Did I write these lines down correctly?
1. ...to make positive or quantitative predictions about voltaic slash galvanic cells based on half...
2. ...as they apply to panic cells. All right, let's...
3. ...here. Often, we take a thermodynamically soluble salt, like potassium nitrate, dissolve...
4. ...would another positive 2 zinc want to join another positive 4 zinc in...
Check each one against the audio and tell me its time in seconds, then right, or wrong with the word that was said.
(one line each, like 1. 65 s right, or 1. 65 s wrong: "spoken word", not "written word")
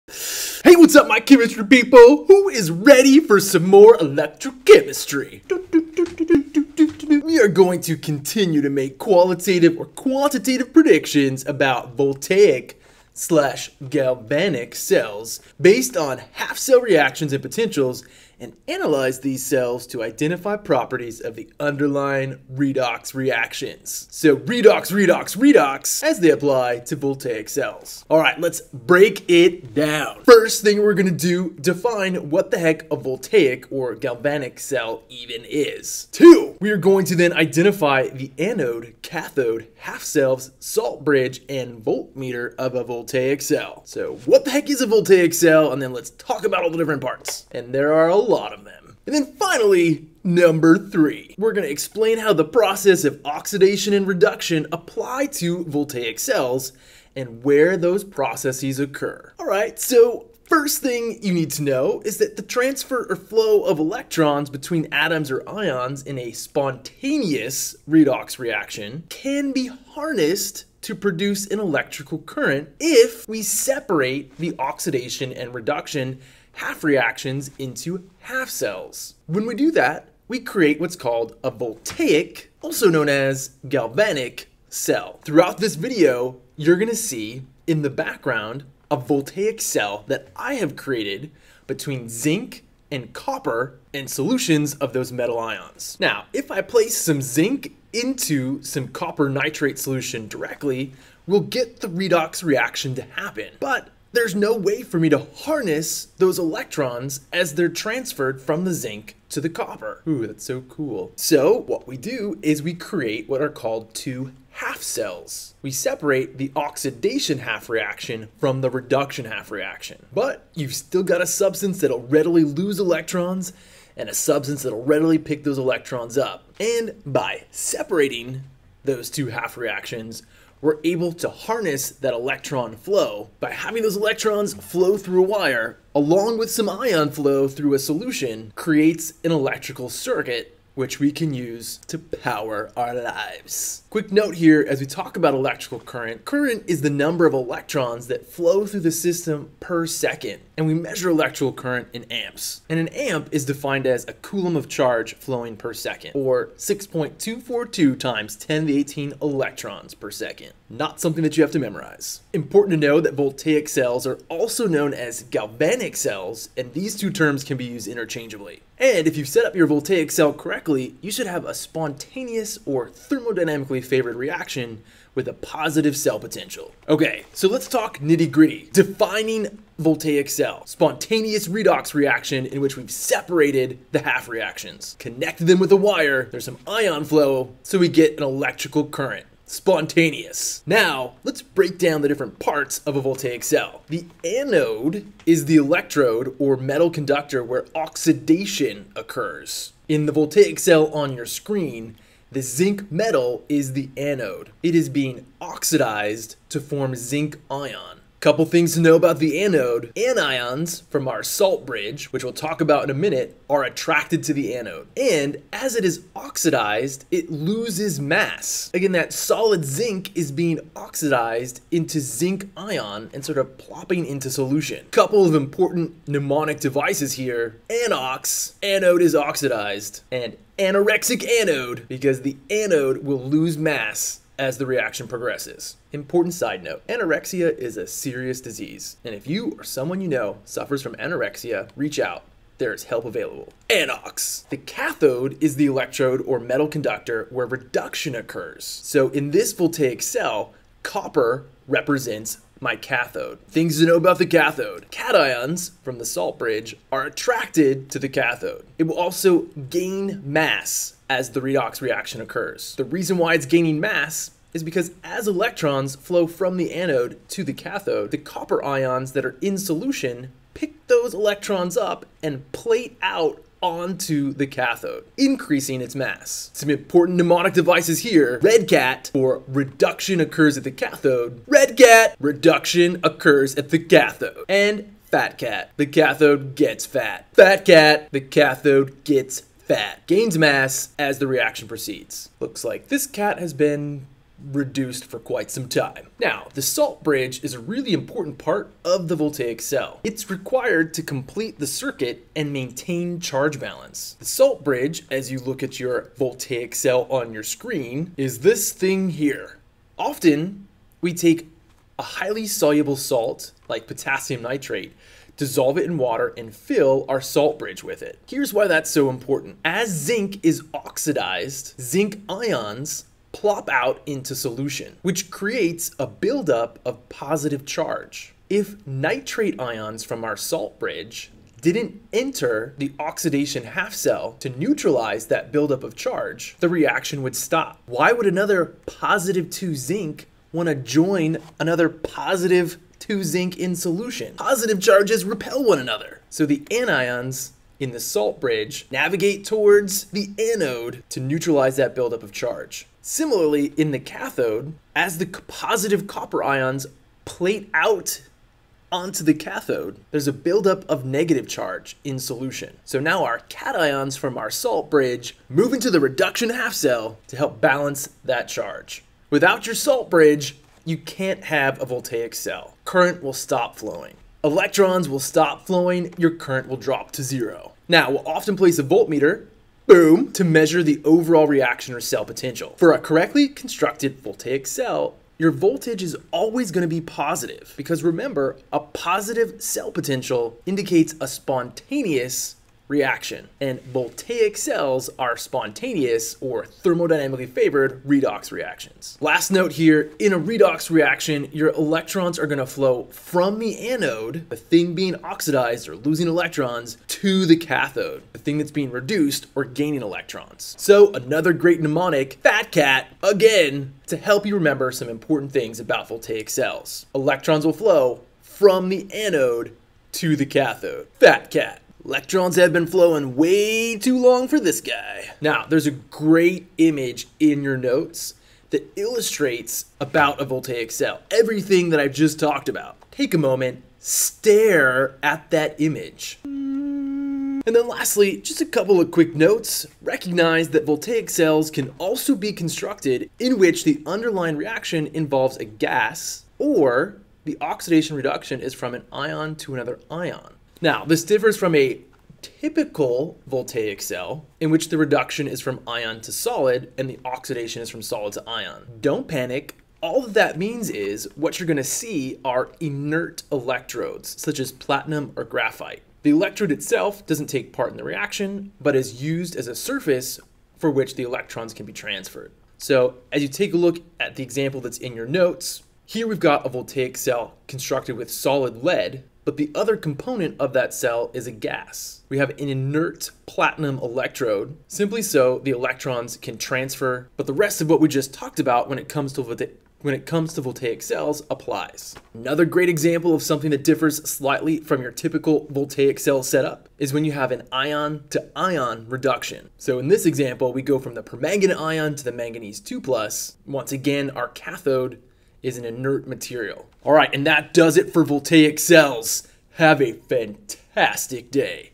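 1. 8 s wrong: "qualitative", not "positive"
2. 26 s wrong: "voltaic", not "panic"
3. 309 s wrong: "highly", not "thermodynamically"
4. 338 s wrong: "2", not "4".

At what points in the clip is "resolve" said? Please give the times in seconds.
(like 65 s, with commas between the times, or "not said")
not said.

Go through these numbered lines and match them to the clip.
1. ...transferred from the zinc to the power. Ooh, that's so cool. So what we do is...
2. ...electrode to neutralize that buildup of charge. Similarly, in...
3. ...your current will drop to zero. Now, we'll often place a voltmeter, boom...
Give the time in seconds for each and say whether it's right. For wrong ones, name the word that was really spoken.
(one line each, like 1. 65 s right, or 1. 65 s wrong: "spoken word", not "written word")
1. 107 s wrong: "copper", not "power"
2. 350 s wrong: "anode", not "electrode"
3. 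376 s right.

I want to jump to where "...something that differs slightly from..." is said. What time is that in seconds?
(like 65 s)
493 s.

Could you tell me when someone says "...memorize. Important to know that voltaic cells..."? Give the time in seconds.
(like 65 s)
161 s.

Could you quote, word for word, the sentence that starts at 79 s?
When we do that, we create what's called a voltaic, also known as galvanic, cell.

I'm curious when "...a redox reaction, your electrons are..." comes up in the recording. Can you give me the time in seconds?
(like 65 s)
400 s.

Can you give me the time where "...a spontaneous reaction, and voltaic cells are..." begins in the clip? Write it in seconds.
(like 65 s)
391 s.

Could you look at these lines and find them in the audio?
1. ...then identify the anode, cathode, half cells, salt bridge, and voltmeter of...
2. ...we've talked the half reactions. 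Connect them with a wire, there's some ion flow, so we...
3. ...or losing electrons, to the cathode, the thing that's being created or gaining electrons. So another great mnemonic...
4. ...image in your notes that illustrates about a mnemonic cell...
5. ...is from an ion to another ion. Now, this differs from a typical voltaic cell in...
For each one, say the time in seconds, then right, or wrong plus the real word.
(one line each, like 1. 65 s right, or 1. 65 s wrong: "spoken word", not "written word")
1. 37 s right
2. 182 s wrong: "separated", not "talked"
3. 405 s wrong: "reduced", not "created"
4. 426 s wrong: "voltaic", not "mnemonic"
5. 448 s right.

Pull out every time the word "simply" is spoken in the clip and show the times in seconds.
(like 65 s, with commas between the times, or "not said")
484 s.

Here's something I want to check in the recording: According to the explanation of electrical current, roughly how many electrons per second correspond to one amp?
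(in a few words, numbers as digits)
6.242 x 10^18.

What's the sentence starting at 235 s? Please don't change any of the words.
Important side note, anorexia is a serious disease, and if you or someone you know suffers from anorexia, reach out.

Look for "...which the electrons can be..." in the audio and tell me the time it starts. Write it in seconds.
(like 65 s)
470 s.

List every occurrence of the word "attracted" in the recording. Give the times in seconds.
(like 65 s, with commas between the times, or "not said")
213 s, 257 s.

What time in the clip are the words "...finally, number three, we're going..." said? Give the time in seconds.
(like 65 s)
49 s.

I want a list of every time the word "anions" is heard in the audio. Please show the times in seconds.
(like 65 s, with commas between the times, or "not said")
209 s, 346 s.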